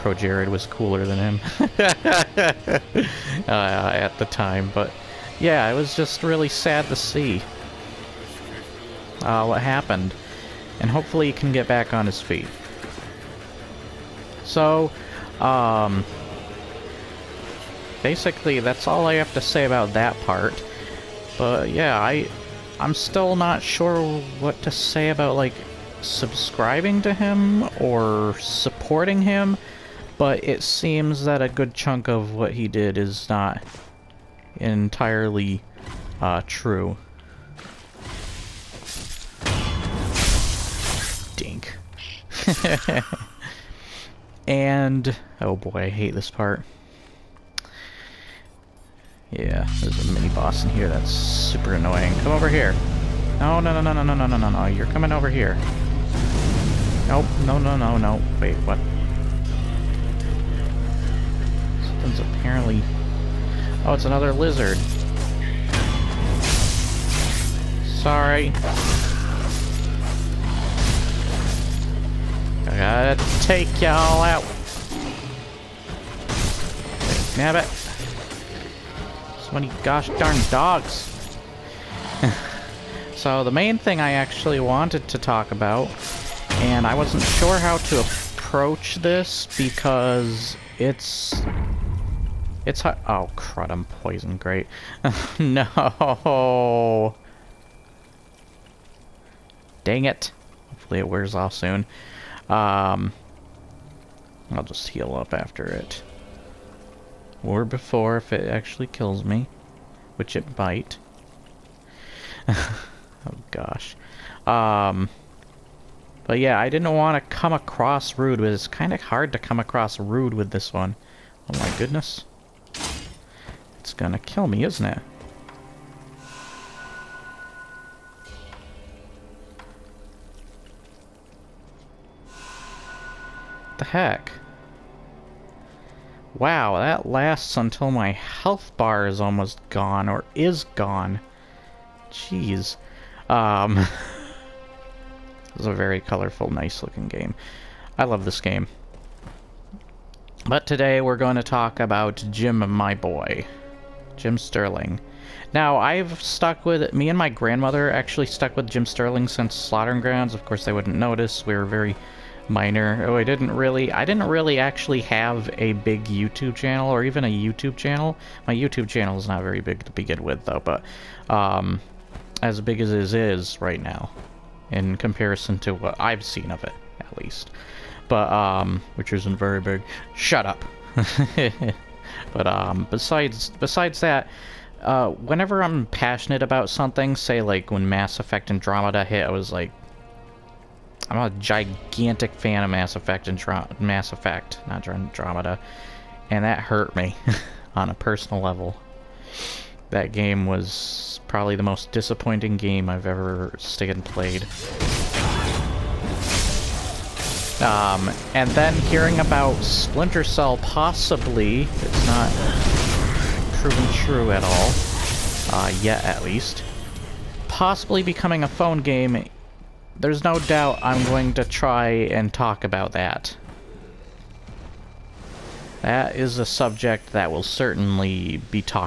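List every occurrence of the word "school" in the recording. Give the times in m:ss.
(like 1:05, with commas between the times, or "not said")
not said.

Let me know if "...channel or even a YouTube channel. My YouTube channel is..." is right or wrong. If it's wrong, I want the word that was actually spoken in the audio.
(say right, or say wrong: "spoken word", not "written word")
right.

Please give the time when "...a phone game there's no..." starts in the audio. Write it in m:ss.
3:38.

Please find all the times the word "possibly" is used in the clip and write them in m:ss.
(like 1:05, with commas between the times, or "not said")
3:30, 3:37.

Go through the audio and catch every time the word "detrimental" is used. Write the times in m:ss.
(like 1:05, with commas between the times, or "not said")
not said.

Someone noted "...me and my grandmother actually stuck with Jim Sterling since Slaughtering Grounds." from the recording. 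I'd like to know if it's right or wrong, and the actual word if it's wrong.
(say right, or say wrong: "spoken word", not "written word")
right.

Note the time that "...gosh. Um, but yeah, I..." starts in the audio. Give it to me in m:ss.
1:53.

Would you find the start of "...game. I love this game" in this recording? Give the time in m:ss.
2:27.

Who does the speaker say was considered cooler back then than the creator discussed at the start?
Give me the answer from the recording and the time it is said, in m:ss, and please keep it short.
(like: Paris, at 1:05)
Jared, at 0:00.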